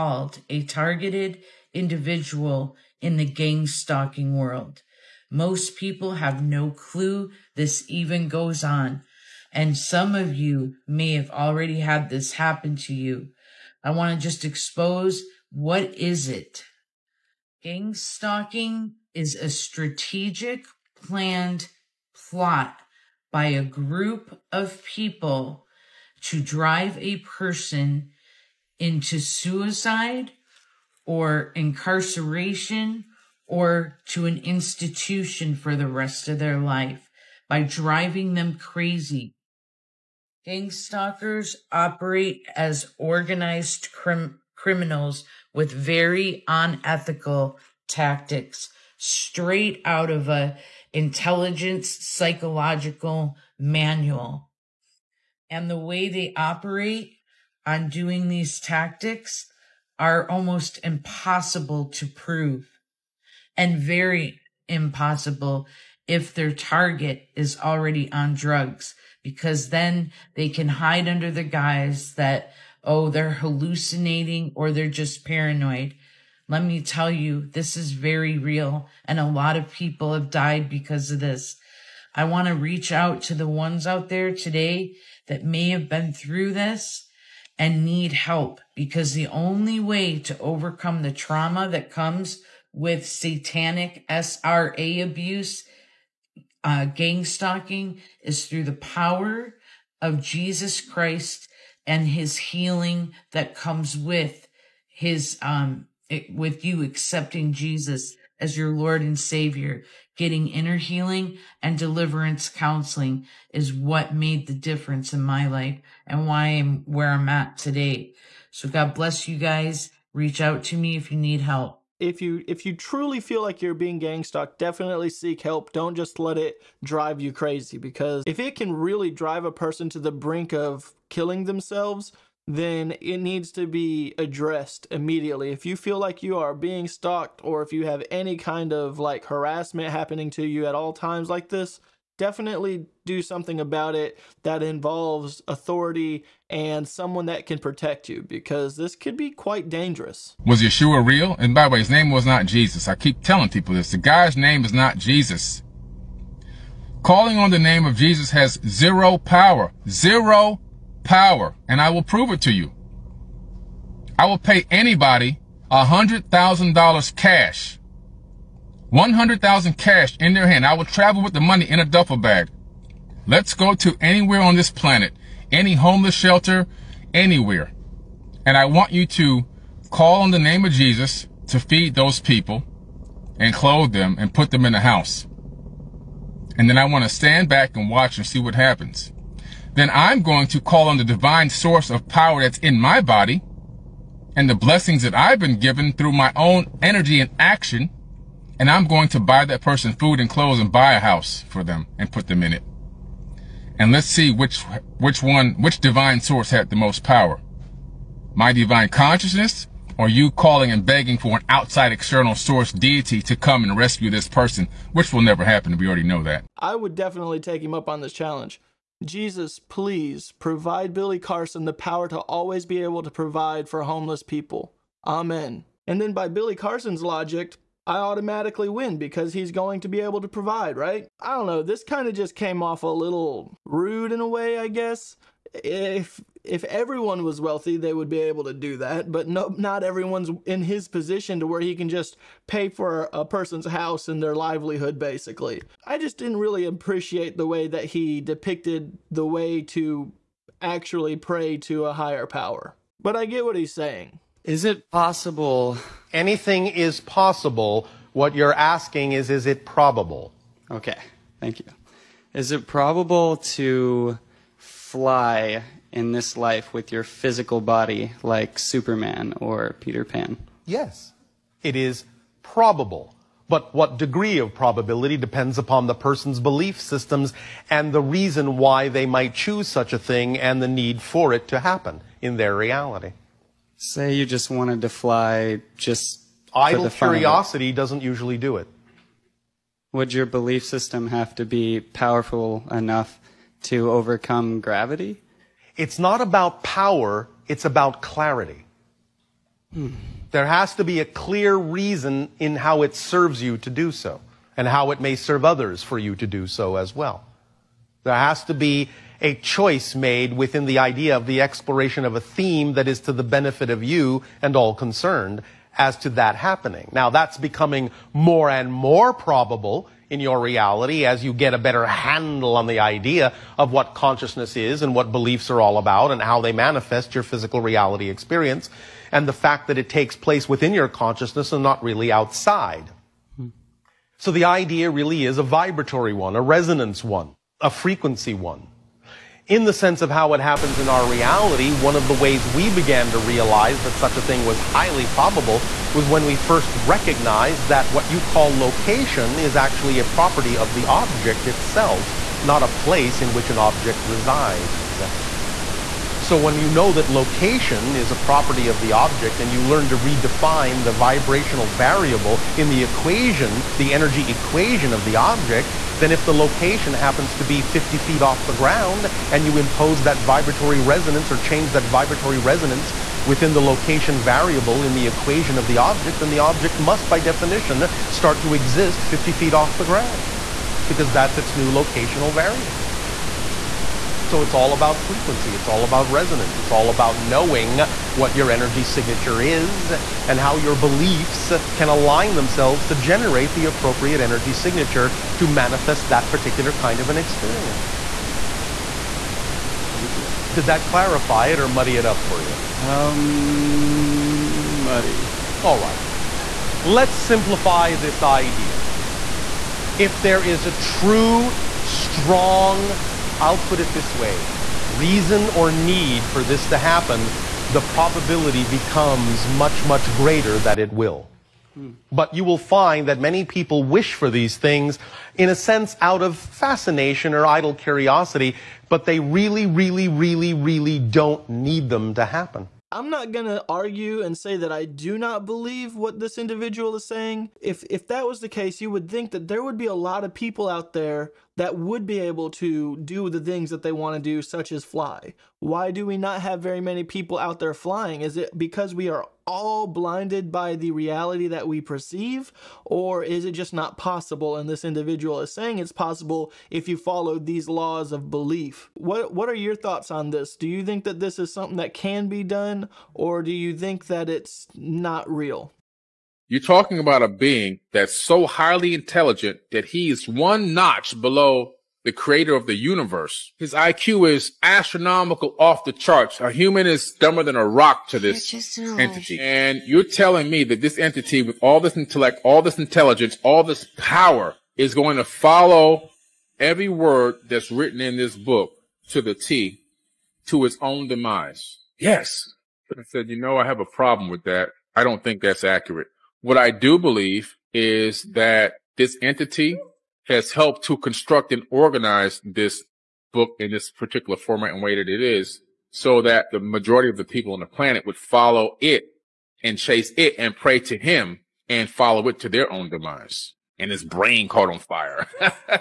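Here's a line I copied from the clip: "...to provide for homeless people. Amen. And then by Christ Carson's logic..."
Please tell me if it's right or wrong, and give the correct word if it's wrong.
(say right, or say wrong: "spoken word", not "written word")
wrong: "Billy", not "Christ".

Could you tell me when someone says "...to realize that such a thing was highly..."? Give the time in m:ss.
5:43.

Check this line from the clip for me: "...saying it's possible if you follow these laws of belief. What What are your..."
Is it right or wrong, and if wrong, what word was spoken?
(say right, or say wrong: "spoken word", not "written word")
right.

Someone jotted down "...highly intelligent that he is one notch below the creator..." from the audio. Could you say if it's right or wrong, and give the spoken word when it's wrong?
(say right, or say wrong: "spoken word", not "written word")
right.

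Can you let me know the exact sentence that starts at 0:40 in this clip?
Gang stalkers operate as organized crim- criminals with very unethical tactics straight out of a intelligence psychological manual.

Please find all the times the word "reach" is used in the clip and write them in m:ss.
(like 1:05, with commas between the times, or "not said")
1:22, 2:00.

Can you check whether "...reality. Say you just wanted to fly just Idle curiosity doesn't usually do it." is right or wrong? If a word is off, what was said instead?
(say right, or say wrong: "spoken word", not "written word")
right.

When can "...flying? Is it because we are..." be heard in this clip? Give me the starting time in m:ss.
7:27.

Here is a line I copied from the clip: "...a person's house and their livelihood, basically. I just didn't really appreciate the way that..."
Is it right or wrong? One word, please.
right.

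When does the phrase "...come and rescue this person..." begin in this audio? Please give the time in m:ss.
3:33.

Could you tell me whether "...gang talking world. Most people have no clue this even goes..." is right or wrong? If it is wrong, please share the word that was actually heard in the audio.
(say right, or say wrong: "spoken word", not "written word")
wrong: "stalking", not "talking".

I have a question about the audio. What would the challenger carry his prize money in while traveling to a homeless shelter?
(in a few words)
A duffel bag.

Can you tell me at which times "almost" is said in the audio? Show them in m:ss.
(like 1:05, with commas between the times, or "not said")
1:00.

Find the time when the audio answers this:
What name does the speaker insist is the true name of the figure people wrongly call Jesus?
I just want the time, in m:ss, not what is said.
2:30.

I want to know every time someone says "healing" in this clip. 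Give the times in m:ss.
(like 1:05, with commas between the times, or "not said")
1:42, 1:50.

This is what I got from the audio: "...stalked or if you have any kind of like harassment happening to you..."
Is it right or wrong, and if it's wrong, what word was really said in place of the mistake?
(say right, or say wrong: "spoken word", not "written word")
right.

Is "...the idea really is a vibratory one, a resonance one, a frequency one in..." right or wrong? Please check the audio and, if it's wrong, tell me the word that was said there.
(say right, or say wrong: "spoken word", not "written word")
right.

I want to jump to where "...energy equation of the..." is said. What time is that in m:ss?
6:03.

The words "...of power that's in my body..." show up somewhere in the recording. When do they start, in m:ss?
3:11.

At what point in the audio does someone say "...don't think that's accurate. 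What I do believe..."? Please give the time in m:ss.
8:15.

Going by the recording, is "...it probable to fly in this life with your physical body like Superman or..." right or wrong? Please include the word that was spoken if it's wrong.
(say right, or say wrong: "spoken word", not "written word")
right.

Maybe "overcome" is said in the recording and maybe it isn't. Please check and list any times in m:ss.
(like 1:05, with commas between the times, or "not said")
1:30, 4:53.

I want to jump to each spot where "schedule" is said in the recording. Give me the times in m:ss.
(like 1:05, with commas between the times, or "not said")
not said.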